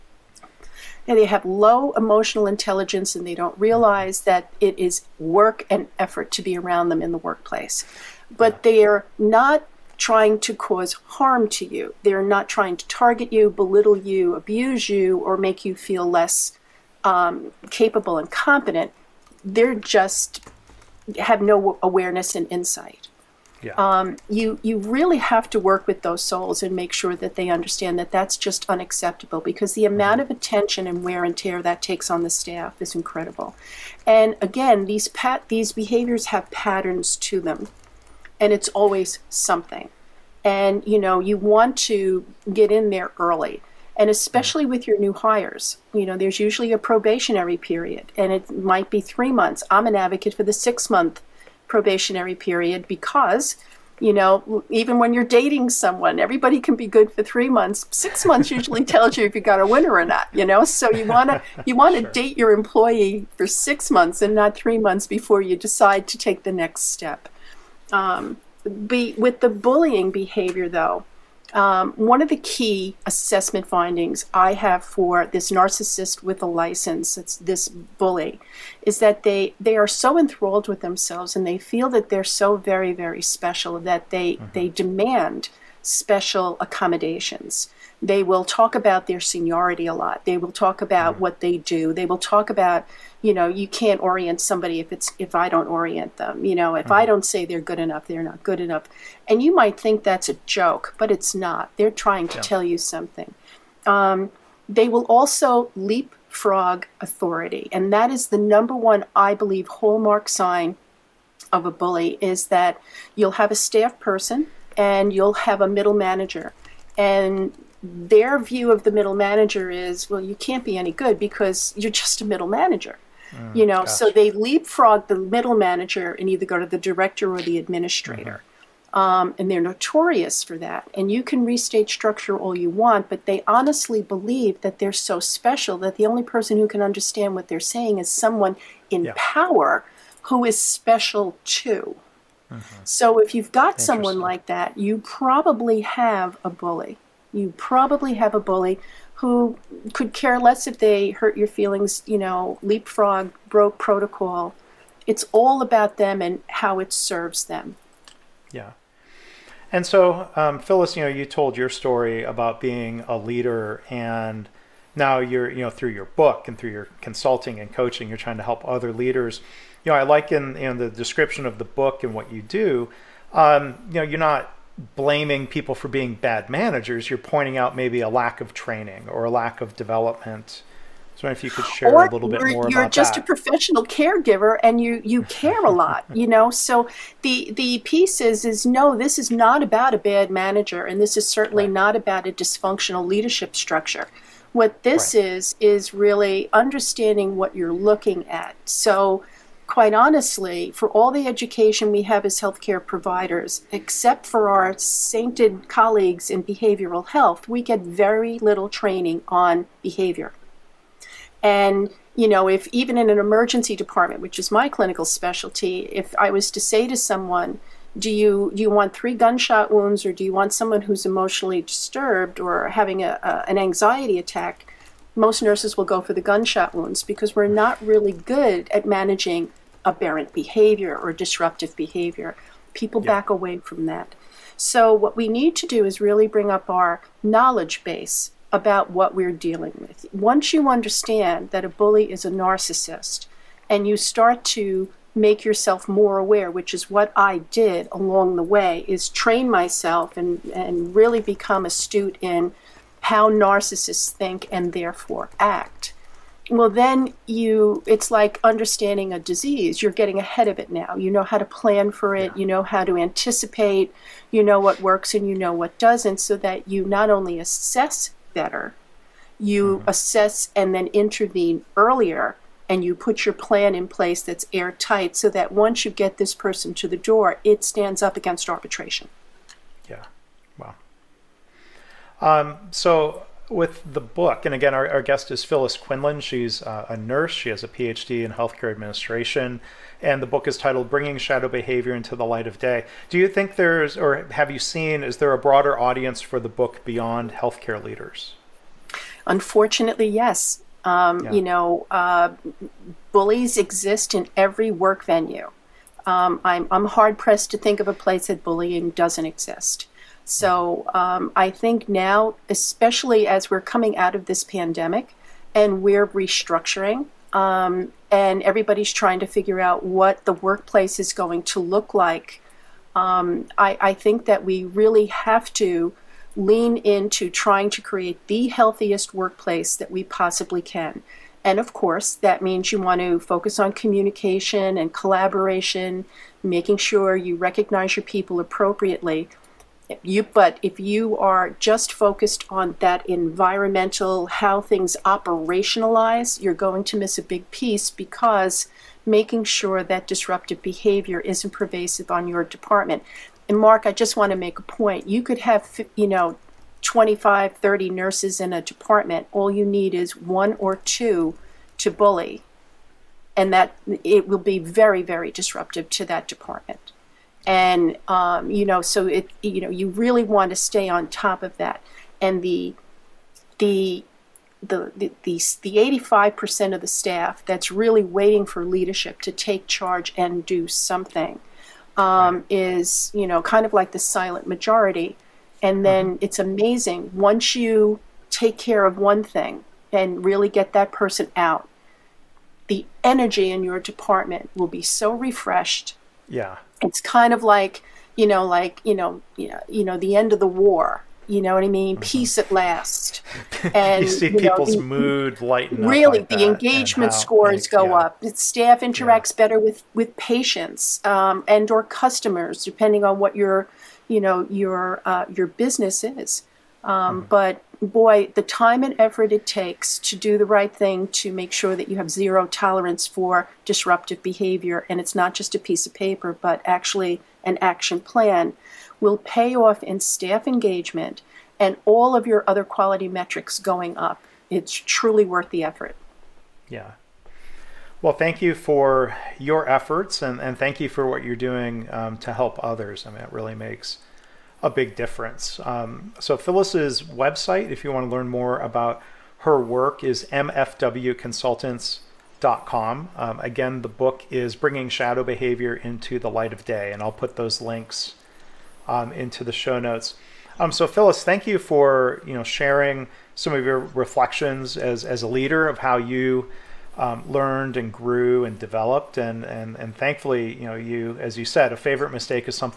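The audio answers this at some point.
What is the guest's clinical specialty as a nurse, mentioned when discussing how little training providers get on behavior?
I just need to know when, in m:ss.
3:33.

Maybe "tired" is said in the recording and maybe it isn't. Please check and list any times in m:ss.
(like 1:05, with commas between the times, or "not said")
not said.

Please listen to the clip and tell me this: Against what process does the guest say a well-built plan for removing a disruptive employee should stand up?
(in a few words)
Arbitration.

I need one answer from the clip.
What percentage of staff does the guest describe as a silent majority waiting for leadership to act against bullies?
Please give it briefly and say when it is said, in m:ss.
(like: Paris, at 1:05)
85%, at 6:15.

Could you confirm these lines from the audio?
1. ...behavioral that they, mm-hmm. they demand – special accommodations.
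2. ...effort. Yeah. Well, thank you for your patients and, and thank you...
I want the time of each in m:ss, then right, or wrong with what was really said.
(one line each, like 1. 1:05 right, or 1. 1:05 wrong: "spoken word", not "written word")
1. 1:23 wrong: "special", not "behavioral"
2. 7:15 wrong: "efforts", not "patients".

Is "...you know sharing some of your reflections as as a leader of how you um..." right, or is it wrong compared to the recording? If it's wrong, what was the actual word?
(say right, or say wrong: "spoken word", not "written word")
right.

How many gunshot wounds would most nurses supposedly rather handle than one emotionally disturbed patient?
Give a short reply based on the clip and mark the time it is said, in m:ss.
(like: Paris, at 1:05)
3, at 3:38.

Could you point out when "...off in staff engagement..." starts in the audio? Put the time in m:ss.
7:09.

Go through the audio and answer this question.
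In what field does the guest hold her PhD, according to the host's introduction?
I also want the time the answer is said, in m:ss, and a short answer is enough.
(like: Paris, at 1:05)
Healthcare administration, at 4:48.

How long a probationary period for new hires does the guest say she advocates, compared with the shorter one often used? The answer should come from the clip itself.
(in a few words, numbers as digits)
6 months.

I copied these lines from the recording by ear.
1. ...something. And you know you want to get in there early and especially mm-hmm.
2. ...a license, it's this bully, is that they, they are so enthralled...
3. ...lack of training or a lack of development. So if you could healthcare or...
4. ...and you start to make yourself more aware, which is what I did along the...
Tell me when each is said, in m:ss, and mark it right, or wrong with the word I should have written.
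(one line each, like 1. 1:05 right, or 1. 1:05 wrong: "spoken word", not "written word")
1. 0:39 right
2. 1:16 right
3. 2:58 wrong: "share", not "healthcare"
4. 4:03 right.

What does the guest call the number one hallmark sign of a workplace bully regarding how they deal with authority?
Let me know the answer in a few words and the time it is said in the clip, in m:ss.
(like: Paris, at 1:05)
Leapfrog authority, at 1:45.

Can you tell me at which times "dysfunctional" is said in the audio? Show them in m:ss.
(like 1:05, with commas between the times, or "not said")
3:12.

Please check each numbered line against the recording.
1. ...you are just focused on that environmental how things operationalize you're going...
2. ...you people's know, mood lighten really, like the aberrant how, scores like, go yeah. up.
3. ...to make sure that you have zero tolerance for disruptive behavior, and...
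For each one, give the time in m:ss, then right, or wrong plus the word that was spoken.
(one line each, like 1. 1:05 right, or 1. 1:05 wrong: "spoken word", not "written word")
1. 5:40 right
2. 6:44 wrong: "engagement", not "aberrant"
3. 7:01 right.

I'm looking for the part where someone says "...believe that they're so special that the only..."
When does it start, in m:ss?
2:13.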